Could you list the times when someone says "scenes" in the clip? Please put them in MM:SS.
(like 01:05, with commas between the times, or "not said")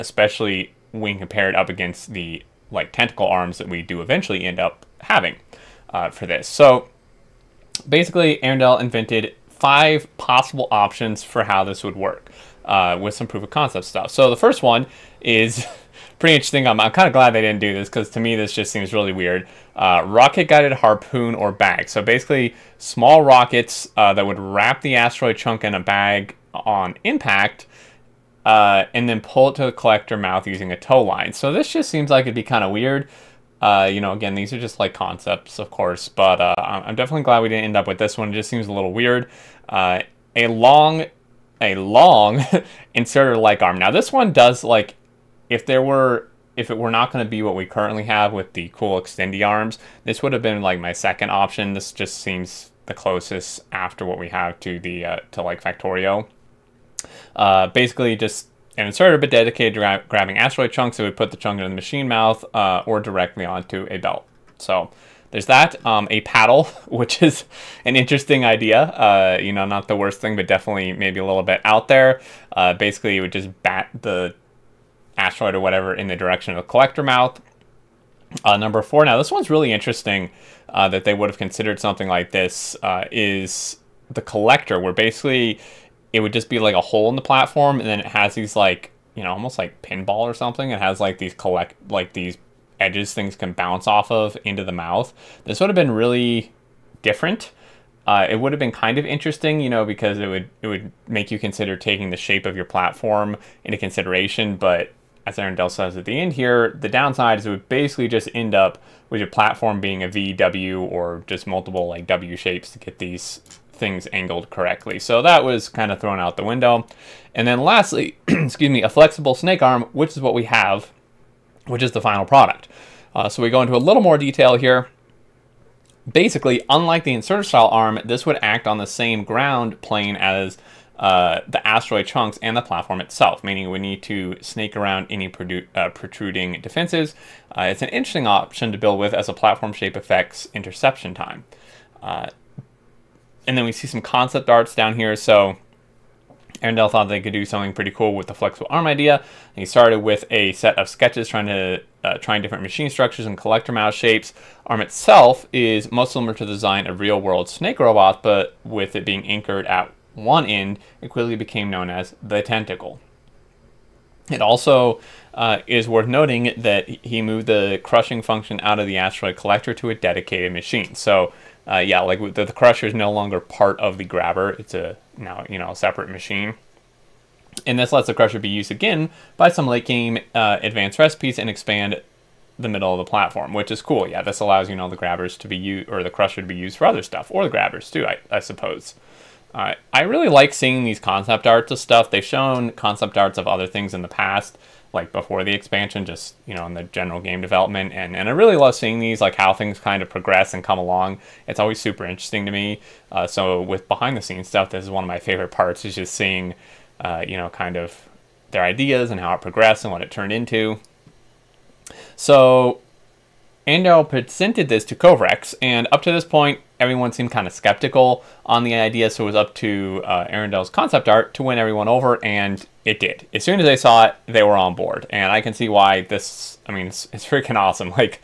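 03:24.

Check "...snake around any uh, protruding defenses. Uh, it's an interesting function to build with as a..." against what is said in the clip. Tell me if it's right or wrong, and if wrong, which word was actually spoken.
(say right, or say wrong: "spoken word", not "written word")
wrong: "option", not "function".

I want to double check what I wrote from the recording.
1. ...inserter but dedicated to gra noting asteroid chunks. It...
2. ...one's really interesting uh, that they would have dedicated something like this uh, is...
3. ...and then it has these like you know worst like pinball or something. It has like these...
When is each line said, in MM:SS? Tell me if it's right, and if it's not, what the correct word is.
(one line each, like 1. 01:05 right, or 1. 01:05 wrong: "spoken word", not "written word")
1. 00:58 wrong: "grabbing", not "noting"
2. 01:19 wrong: "considered", not "dedicated"
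3. 01:27 wrong: "almost", not "worst".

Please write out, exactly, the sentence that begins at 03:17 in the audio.
And, and I really love seeing these, like how things kind of progress and come along.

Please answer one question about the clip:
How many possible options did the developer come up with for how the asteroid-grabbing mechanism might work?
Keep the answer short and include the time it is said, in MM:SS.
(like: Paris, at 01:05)
5, at 00:09.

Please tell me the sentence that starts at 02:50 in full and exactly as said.
So, uh, yeah, like the, the crusher is no longer part of the grabber.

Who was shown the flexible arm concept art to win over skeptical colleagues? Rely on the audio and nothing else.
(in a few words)
kovarex.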